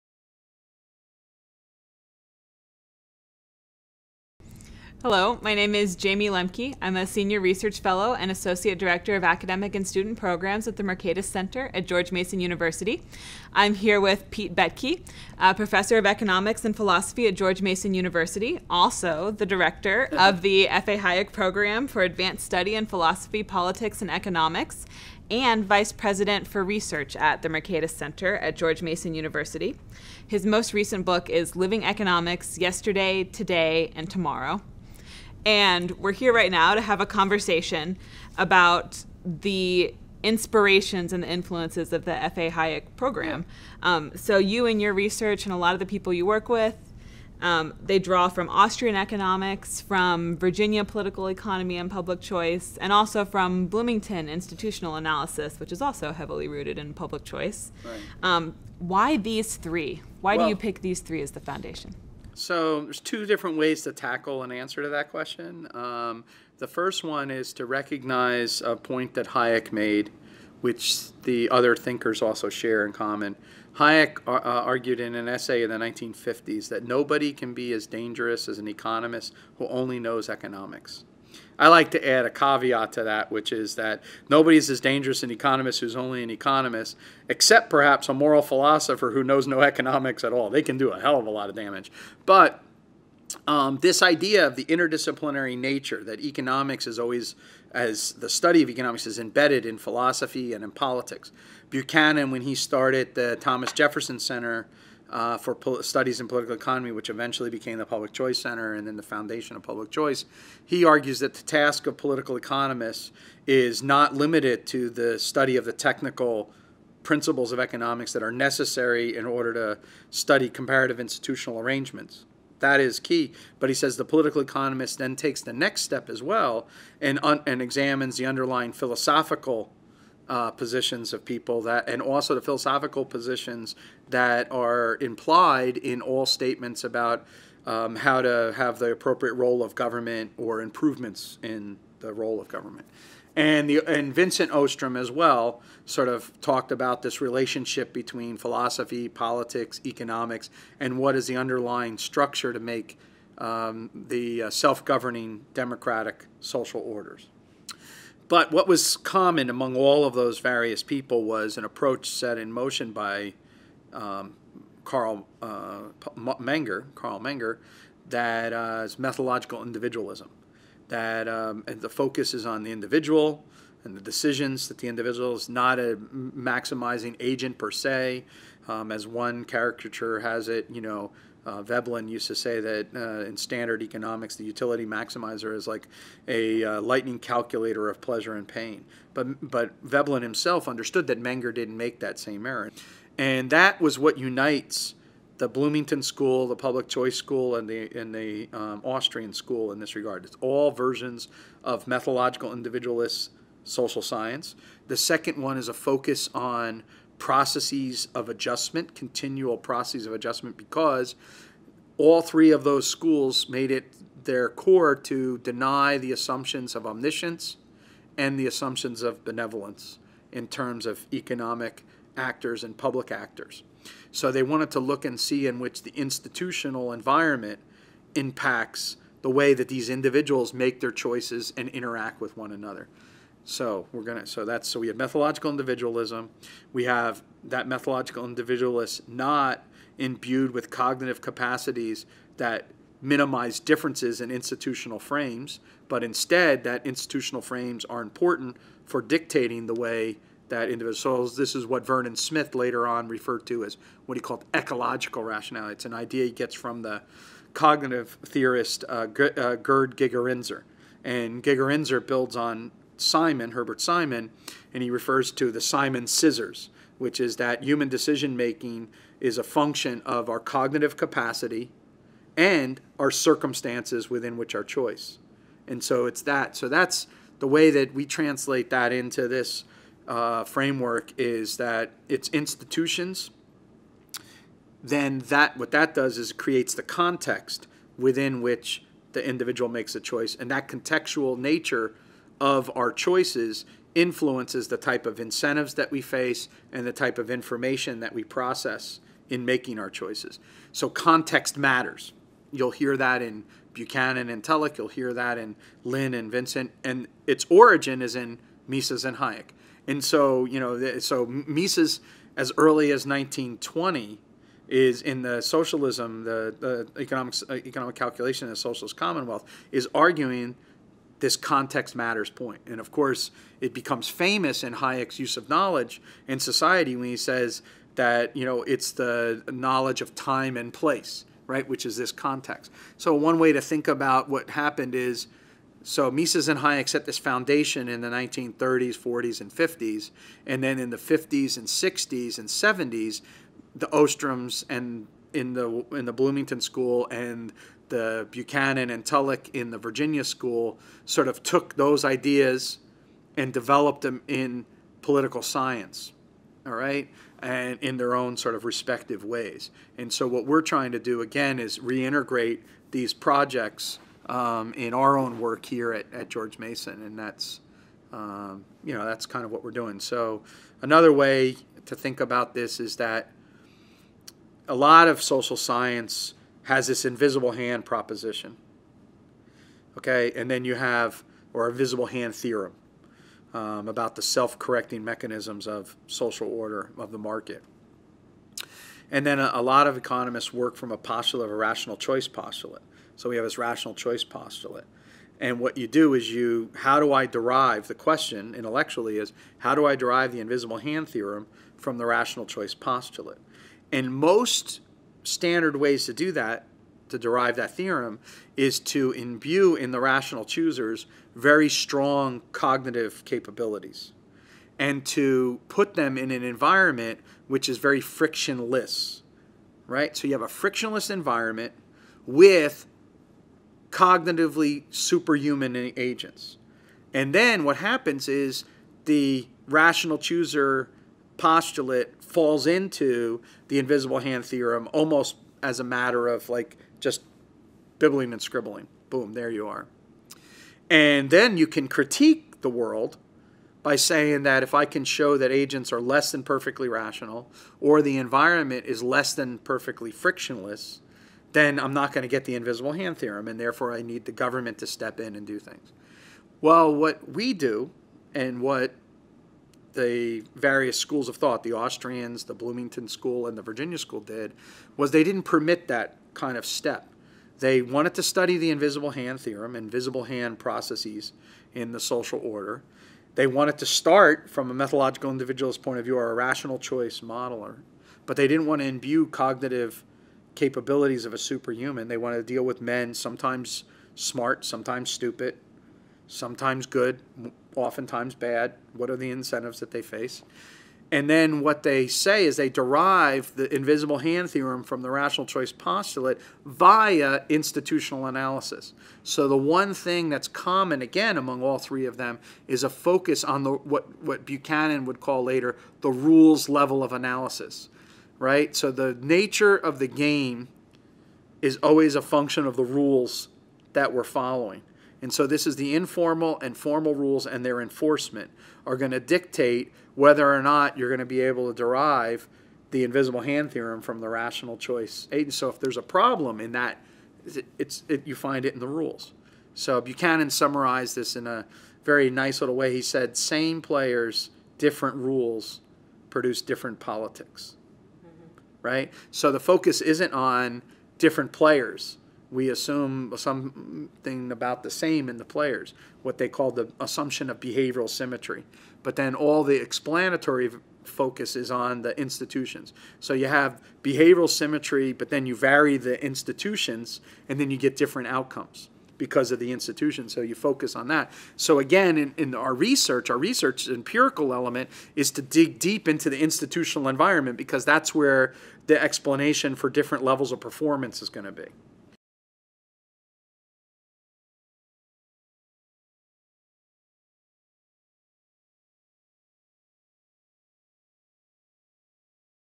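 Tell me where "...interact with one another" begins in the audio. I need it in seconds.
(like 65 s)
231 s.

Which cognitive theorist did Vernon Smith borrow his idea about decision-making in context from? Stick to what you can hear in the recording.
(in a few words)
Gerd Gigerenzer.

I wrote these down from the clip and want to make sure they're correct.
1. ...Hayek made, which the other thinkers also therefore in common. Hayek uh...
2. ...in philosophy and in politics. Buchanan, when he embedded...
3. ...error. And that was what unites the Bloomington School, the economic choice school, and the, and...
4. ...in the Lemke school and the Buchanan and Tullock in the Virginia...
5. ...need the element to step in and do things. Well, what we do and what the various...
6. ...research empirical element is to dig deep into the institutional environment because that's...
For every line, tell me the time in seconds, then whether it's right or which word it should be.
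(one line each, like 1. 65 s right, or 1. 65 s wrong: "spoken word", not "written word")
1. 69 s wrong: "share", not "therefore"
2. 99 s wrong: "started", not "embedded"
3. 192 s wrong: "public", not "economic"
4. 345 s wrong: "Bloomington", not "Lemke"
5. 454 s wrong: "government", not "element"
6. 563 s right.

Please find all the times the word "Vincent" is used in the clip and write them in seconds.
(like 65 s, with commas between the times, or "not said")
144 s, 306 s.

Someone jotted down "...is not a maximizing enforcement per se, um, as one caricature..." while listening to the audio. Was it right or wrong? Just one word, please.
wrong.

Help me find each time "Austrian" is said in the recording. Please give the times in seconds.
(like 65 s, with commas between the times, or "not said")
48 s, 198 s, 461 s.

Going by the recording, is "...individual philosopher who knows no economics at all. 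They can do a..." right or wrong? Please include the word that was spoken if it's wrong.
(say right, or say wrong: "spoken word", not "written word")
wrong: "moral", not "individual".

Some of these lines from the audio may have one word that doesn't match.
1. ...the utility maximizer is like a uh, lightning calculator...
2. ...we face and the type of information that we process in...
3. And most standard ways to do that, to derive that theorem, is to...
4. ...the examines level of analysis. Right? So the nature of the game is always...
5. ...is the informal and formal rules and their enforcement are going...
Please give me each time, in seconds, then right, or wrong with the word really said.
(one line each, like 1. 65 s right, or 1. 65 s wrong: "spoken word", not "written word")
1. 184 s right
2. 295 s right
3. 403 s right
4. 505 s wrong: "rules", not "examines"
5. 515 s right.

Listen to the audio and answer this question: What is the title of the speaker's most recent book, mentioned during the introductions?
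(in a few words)
Living Economics Yesterday, Today, and Tomorrow.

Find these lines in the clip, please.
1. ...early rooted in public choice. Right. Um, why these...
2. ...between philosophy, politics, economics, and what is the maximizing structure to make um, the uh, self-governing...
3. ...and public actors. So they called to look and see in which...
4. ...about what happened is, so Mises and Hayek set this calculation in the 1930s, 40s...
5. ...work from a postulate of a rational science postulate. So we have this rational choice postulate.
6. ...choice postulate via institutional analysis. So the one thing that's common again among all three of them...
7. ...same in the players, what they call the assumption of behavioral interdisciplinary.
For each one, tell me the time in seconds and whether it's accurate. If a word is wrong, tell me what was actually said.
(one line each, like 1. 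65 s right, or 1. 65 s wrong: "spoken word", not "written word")
1. 56 s wrong: "heavily", not "early"
2. 147 s wrong: "underlying", not "maximizing"
3. 222 s wrong: "wanted", not "called"
4. 333 s wrong: "foundation", not "calculation"
5. 390 s wrong: "choice", not "science"
6. 495 s right
7. 544 s wrong: "symmetry", not "interdisciplinary".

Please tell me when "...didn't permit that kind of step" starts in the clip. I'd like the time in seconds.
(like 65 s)
465 s.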